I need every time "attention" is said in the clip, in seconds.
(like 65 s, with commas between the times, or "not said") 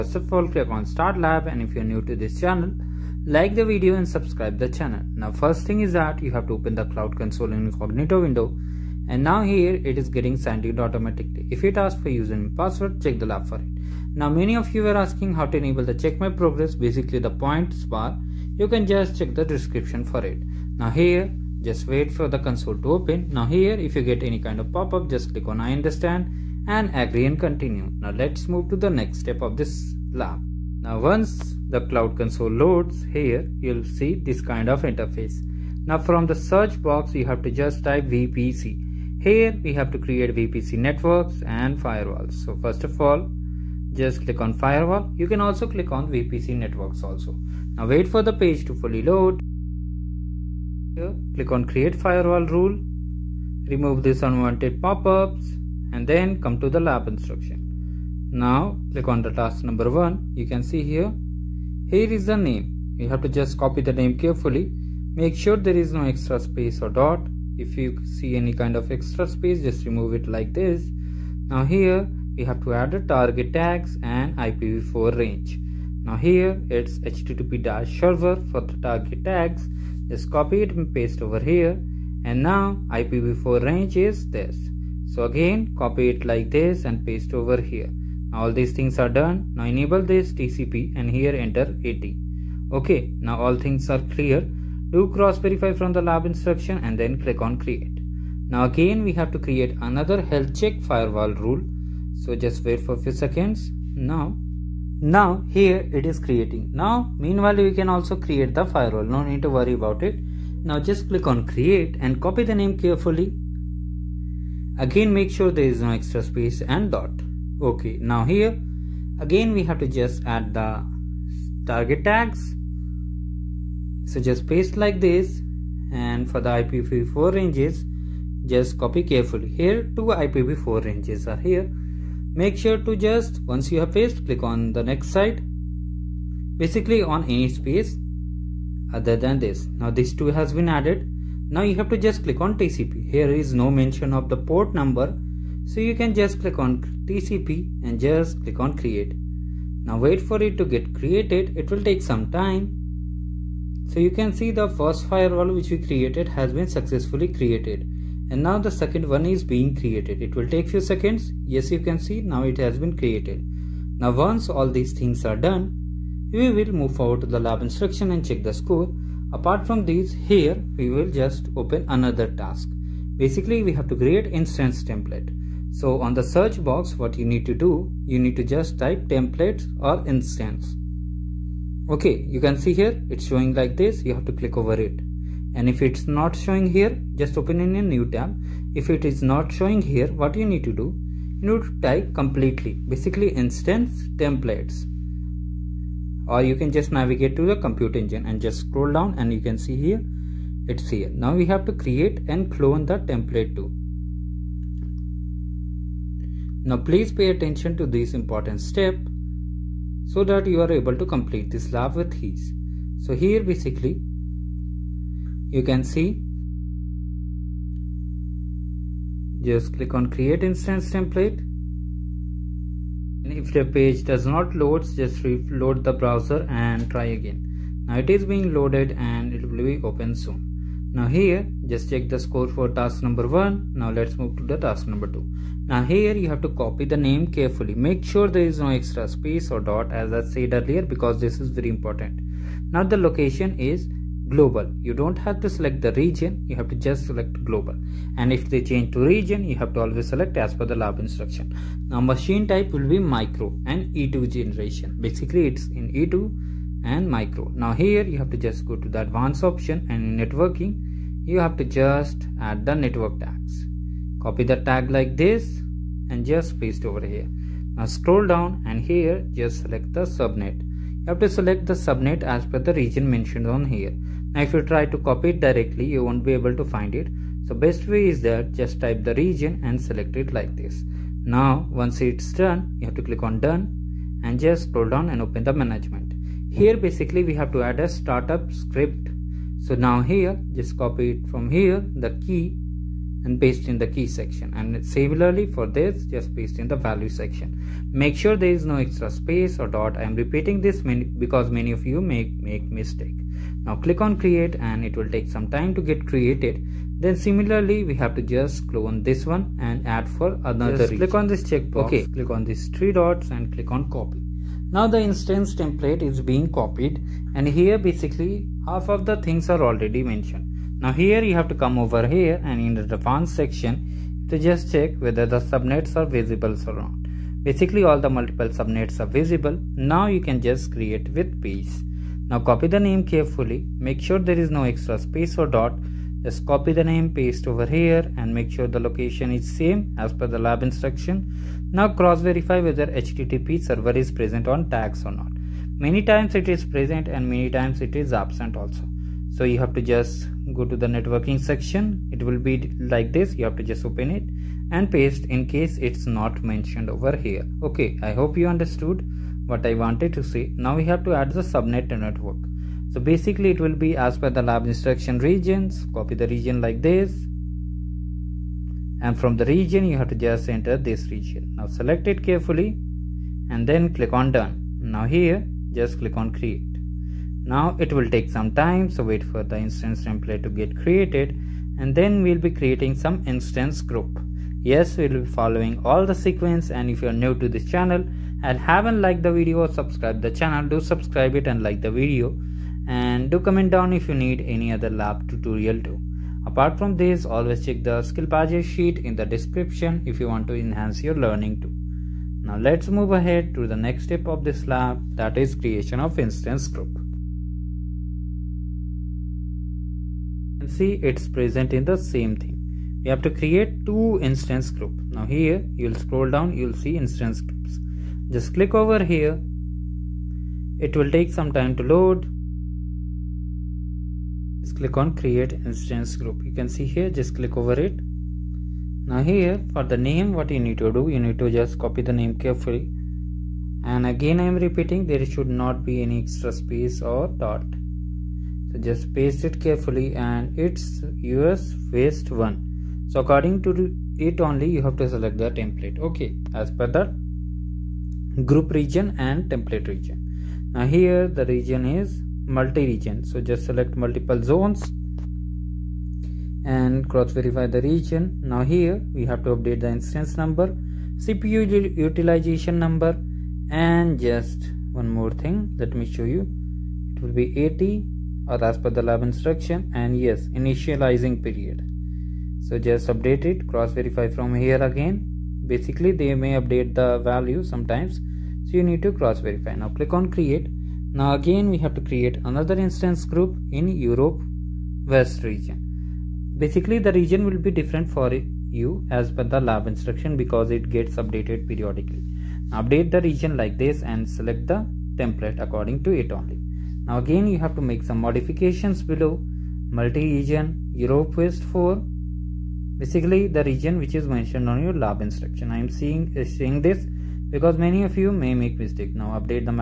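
207 s.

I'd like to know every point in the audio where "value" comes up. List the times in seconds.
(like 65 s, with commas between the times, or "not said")
296 s, 477 s.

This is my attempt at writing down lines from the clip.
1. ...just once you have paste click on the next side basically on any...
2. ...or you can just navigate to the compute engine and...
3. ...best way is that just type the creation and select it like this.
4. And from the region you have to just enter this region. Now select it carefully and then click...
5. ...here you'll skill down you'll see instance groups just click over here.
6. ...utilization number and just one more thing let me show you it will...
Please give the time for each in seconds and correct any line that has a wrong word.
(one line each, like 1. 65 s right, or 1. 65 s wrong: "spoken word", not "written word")
1. 133 s right
2. 196 s right
3. 277 s wrong: "region", not "creation"
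4. 368 s right
5. 415 s wrong: "scroll", not "skill"
6. 461 s right.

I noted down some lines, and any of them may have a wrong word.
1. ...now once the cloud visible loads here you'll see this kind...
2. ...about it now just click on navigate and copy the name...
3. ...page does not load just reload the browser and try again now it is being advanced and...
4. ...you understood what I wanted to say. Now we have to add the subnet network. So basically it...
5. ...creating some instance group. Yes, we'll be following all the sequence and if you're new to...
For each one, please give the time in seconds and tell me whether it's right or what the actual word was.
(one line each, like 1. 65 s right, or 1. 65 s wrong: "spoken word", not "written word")
1. 30 s wrong: "console", not "visible"
2. 109 s wrong: "create", not "navigate"
3. 223 s wrong: "loaded", not "advanced"
4. 358 s right
5. 382 s right.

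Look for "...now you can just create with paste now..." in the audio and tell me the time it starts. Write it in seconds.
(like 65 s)
329 s.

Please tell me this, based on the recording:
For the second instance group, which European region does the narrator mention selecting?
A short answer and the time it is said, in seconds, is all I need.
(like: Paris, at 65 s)
europe west 4, at 500 s.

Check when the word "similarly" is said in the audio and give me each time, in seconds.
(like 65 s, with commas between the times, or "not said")
294 s, 307 s.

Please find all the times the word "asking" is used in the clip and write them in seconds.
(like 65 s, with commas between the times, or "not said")
15 s.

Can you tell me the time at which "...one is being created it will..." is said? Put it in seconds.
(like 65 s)
159 s.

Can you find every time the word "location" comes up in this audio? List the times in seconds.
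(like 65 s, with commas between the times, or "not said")
242 s, 338 s.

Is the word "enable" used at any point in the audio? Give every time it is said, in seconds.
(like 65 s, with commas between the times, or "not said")
15 s, 89 s.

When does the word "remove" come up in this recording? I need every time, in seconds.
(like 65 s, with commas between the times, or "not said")
53 s, 69 s.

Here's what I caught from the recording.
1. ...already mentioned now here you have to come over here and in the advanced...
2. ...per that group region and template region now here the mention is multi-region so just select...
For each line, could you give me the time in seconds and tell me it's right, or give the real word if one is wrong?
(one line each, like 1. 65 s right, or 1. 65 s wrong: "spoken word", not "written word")
1. 319 s right
2. 446 s wrong: "region", not "mention".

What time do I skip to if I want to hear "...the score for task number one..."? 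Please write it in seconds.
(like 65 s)
232 s.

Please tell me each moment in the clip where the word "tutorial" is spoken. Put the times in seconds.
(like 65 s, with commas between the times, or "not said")
395 s.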